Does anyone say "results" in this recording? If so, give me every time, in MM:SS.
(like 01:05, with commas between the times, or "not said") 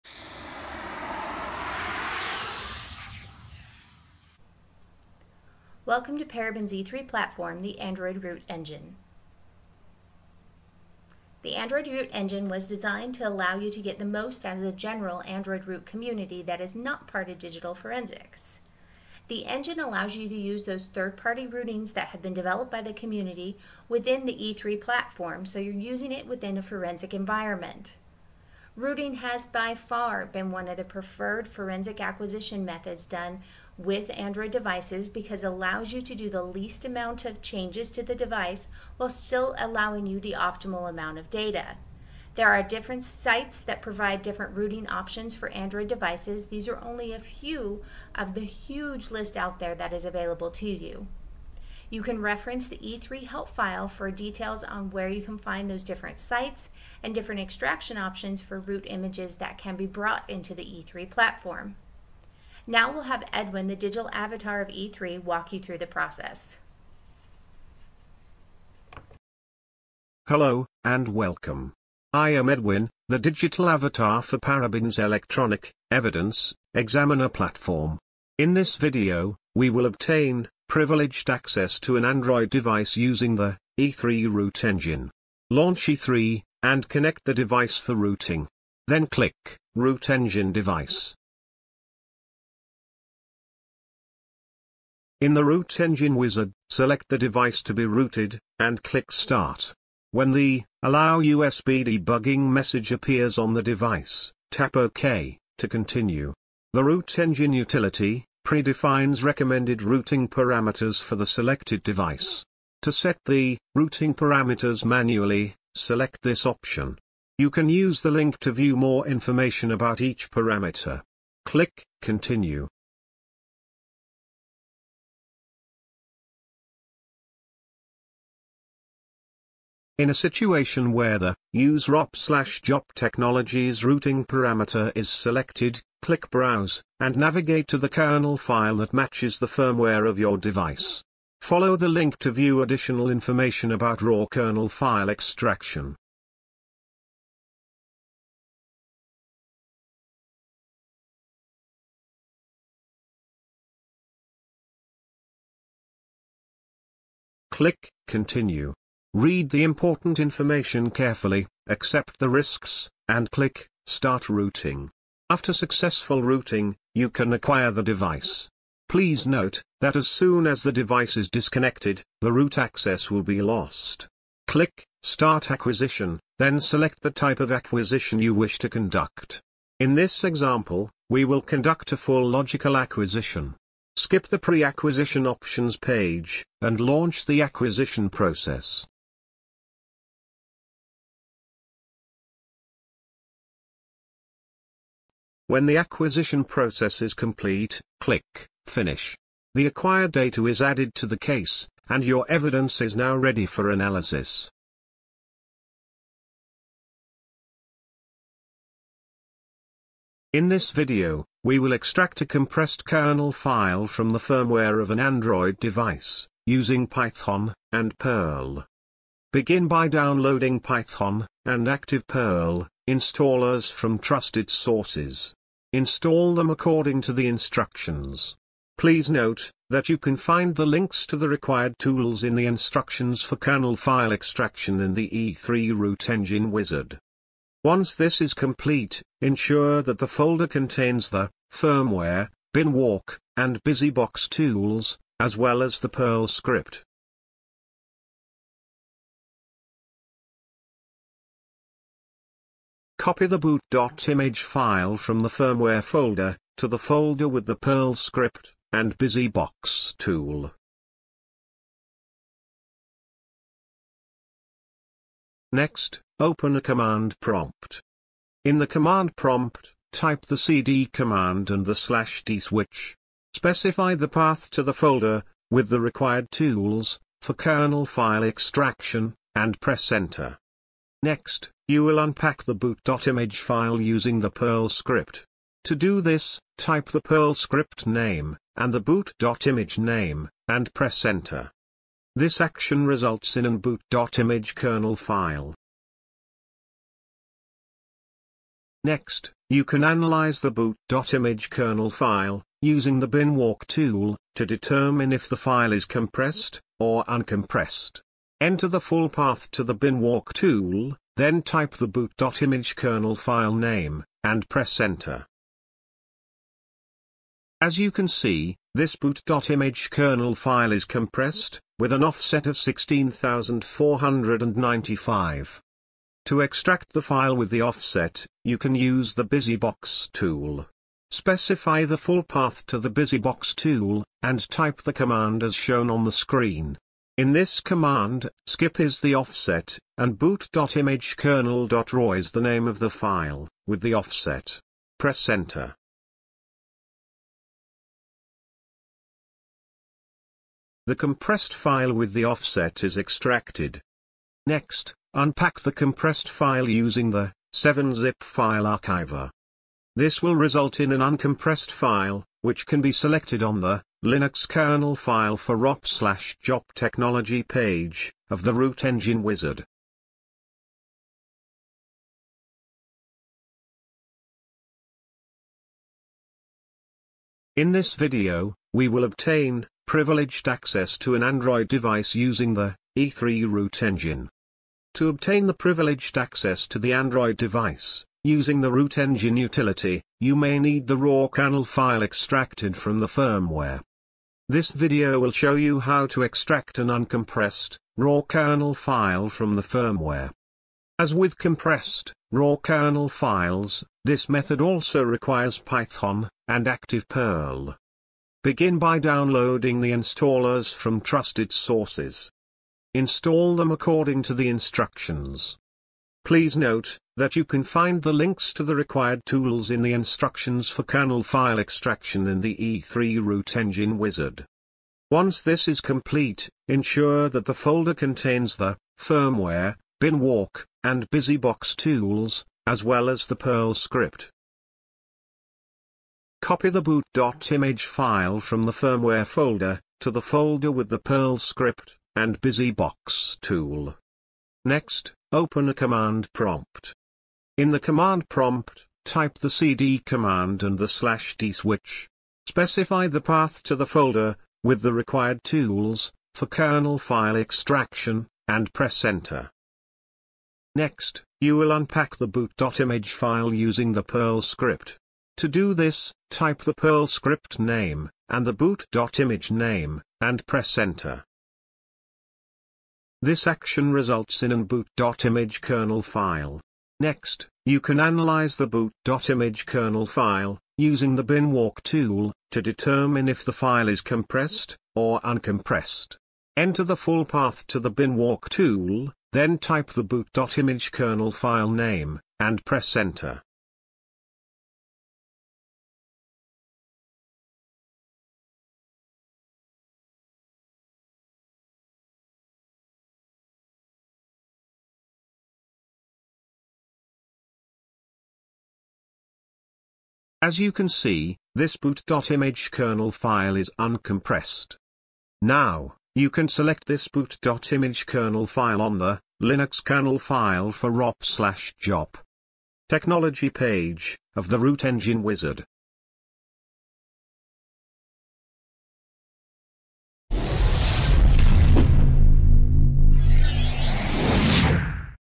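04:52, 06:00, 07:53.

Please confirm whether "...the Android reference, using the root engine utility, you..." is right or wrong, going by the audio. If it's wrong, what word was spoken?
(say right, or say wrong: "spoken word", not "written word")
wrong: "device", not "reference".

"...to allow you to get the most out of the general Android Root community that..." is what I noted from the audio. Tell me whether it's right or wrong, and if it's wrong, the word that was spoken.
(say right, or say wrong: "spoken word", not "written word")
right.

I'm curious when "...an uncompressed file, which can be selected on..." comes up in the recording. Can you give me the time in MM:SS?
06:00.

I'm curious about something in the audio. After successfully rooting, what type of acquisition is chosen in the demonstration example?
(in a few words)
full logical.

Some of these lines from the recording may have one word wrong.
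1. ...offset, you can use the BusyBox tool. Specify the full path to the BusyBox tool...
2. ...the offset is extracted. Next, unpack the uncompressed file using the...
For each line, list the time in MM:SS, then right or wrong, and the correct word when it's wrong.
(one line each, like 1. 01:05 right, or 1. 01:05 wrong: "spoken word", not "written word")
1. 05:27 right
2. 05:52 wrong: "compressed", not "uncompressed".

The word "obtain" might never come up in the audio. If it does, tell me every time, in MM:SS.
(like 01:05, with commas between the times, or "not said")
01:19, 06:19, 06:25.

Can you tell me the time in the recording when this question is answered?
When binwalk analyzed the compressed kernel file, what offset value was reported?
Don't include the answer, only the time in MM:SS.
05:22.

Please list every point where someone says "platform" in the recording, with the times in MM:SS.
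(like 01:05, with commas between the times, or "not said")
00:07, 00:24, 01:01, 01:17.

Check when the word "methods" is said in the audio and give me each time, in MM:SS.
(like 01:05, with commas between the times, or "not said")
00:32, 06:44.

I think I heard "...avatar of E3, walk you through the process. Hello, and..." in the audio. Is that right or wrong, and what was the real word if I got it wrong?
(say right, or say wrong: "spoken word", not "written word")
right.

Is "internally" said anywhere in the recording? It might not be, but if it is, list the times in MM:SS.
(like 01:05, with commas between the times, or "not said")
not said.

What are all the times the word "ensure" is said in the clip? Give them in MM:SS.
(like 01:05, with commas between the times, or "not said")
03:59, 07:06.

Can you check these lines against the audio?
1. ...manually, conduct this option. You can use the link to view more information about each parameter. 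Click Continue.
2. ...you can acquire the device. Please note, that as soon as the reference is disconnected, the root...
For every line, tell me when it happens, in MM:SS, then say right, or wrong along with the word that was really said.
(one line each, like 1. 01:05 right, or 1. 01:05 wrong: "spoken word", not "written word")
1. 01:54 wrong: "select", not "conduct"
2. 02:46 wrong: "device", not "reference".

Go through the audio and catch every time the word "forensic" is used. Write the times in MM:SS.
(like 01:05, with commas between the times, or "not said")
00:17, 00:26, 00:31.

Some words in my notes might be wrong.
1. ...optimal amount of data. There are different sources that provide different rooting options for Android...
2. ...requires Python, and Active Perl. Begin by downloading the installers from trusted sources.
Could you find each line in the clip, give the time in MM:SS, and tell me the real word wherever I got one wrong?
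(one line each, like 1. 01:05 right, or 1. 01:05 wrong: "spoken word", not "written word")
1. 00:40 wrong: "sites", not "sources"
2. 06:45 right.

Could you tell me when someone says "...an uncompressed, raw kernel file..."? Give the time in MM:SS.
06:36.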